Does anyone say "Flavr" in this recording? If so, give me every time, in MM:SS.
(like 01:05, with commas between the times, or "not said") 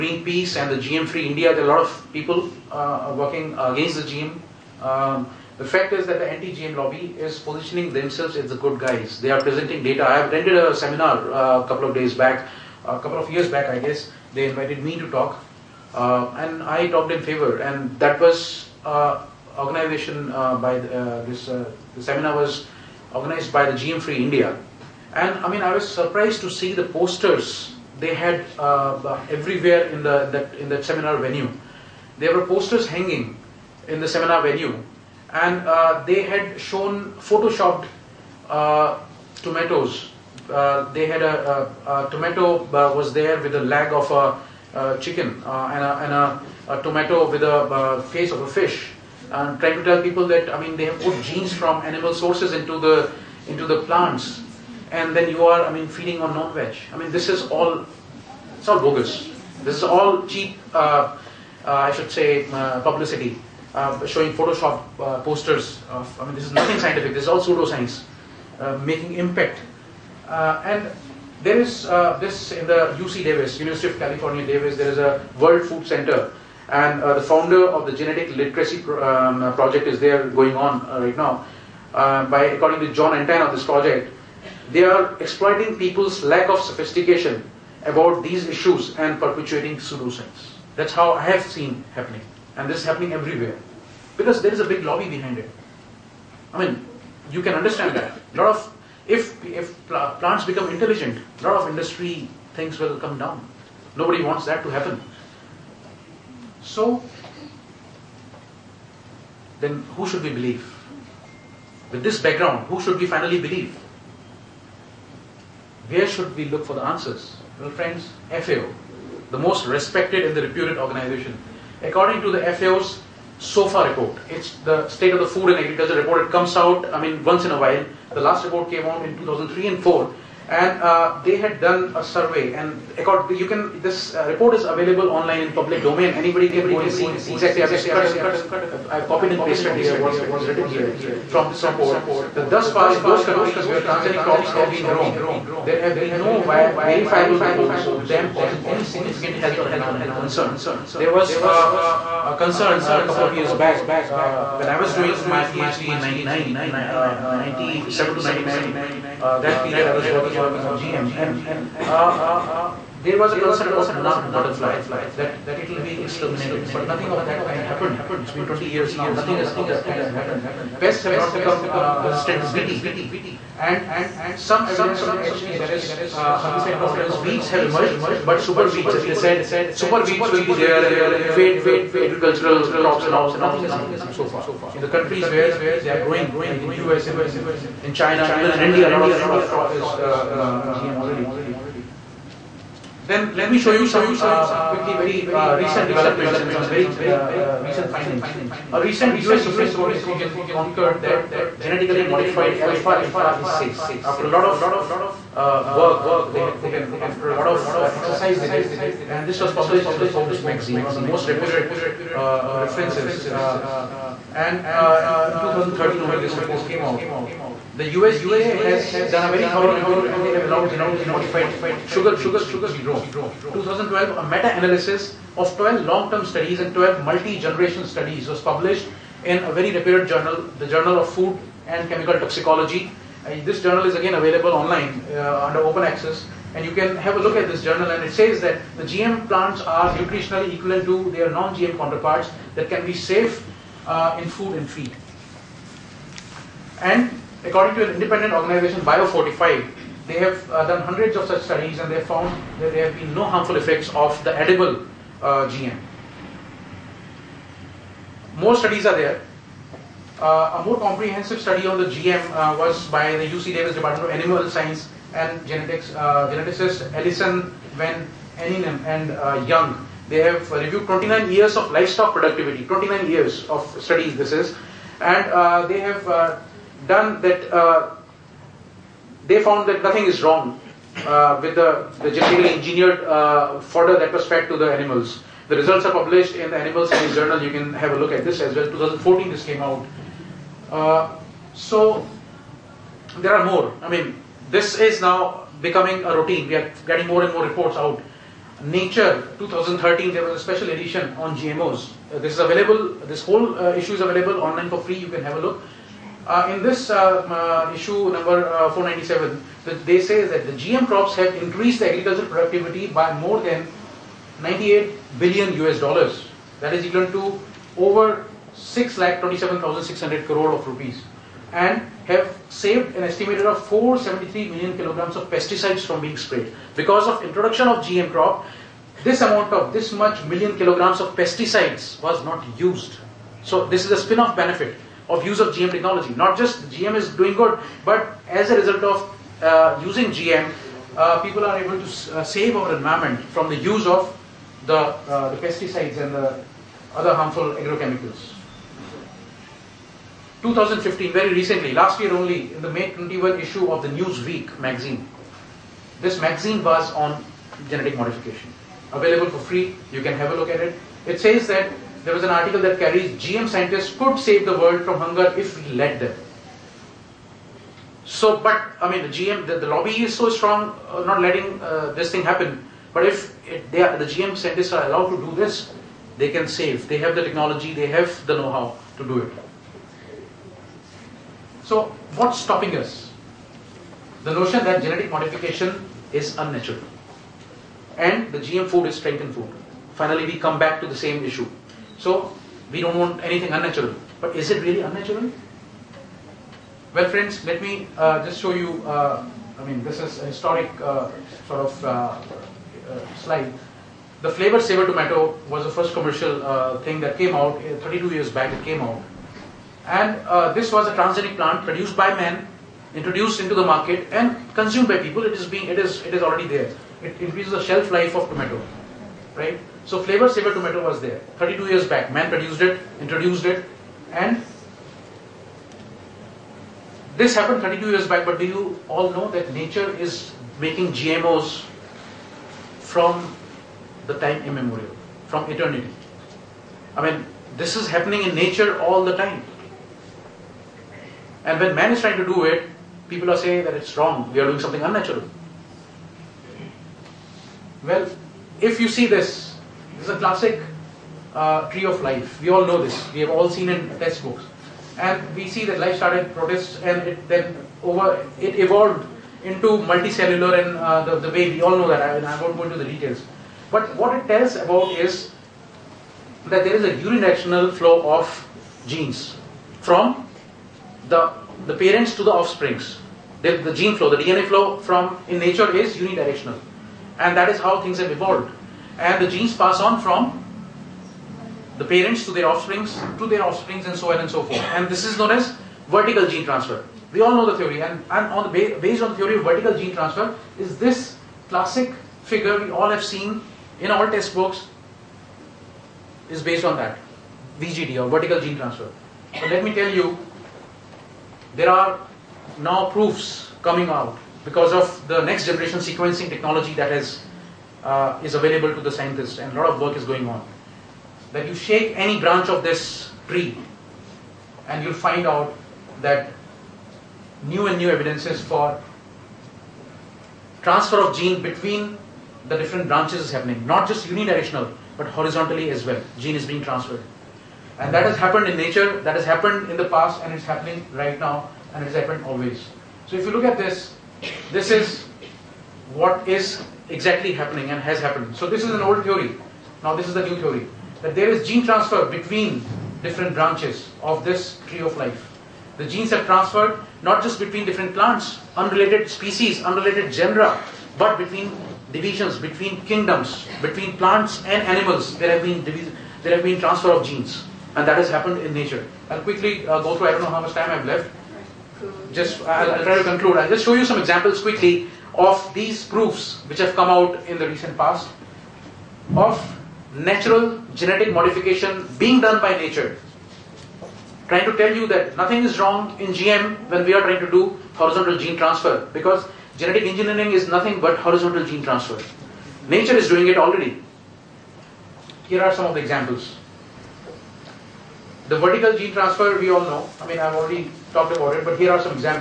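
06:44, 07:00.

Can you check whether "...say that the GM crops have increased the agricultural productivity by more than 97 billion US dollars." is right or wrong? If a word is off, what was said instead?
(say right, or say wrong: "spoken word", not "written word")
wrong: "98", not "97".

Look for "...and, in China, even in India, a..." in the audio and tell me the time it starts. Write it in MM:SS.
03:07.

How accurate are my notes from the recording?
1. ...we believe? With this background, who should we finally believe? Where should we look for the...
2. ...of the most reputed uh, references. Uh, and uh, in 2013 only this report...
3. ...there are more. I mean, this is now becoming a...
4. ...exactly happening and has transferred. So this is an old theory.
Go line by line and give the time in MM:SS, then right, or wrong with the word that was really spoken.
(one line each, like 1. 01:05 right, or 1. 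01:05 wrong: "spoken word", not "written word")
1. 01:50 right
2. 03:30 right
3. 04:53 right
4. 08:56 wrong: "happened", not "transferred".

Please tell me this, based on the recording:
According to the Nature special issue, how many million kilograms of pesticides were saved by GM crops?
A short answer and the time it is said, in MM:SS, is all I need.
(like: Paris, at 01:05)
473, at 05:23.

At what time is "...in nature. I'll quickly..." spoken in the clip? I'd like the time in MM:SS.
09:18.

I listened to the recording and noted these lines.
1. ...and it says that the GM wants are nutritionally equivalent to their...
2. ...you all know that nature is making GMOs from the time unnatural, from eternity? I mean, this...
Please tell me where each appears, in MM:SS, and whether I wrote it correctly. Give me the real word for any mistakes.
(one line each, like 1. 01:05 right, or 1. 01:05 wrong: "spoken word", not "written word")
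1. 03:57 wrong: "plants", not "wants"
2. 07:08 wrong: "immemorial", not "unnatural".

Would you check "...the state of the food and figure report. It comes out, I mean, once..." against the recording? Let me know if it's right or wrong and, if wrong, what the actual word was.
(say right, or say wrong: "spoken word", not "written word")
wrong: "agriculture", not "figure".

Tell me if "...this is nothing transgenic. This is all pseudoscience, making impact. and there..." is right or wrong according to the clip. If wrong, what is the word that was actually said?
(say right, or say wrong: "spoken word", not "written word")
wrong: "scientific", not "transgenic".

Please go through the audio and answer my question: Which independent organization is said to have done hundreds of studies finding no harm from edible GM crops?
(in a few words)
Biofortified.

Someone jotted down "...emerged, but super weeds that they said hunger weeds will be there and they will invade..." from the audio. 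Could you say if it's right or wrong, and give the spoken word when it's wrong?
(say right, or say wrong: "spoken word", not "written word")
wrong: "super", not "hunger".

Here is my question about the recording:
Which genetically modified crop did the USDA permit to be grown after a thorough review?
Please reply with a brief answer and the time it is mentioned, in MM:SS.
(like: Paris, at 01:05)
sugar beets, at 03:41.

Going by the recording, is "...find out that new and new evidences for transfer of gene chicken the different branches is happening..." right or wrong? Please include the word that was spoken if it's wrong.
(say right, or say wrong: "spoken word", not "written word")
wrong: "between", not "chicken".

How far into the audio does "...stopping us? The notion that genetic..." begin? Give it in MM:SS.
06:22.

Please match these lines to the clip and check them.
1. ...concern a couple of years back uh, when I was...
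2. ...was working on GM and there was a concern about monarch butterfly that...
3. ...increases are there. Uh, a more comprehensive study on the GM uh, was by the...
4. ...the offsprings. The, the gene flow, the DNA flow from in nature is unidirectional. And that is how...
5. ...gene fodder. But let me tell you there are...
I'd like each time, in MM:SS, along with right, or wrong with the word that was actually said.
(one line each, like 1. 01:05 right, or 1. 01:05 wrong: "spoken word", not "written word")
1. 02:32 right
2. 02:39 right
3. 04:18 wrong: "studies", not "increases"
4. 07:52 right
5. 08:18 wrong: "transfer", not "fodder".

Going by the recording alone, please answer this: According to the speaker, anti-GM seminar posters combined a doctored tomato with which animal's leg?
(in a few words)
chicken.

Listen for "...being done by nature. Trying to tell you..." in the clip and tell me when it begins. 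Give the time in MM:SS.
09:31.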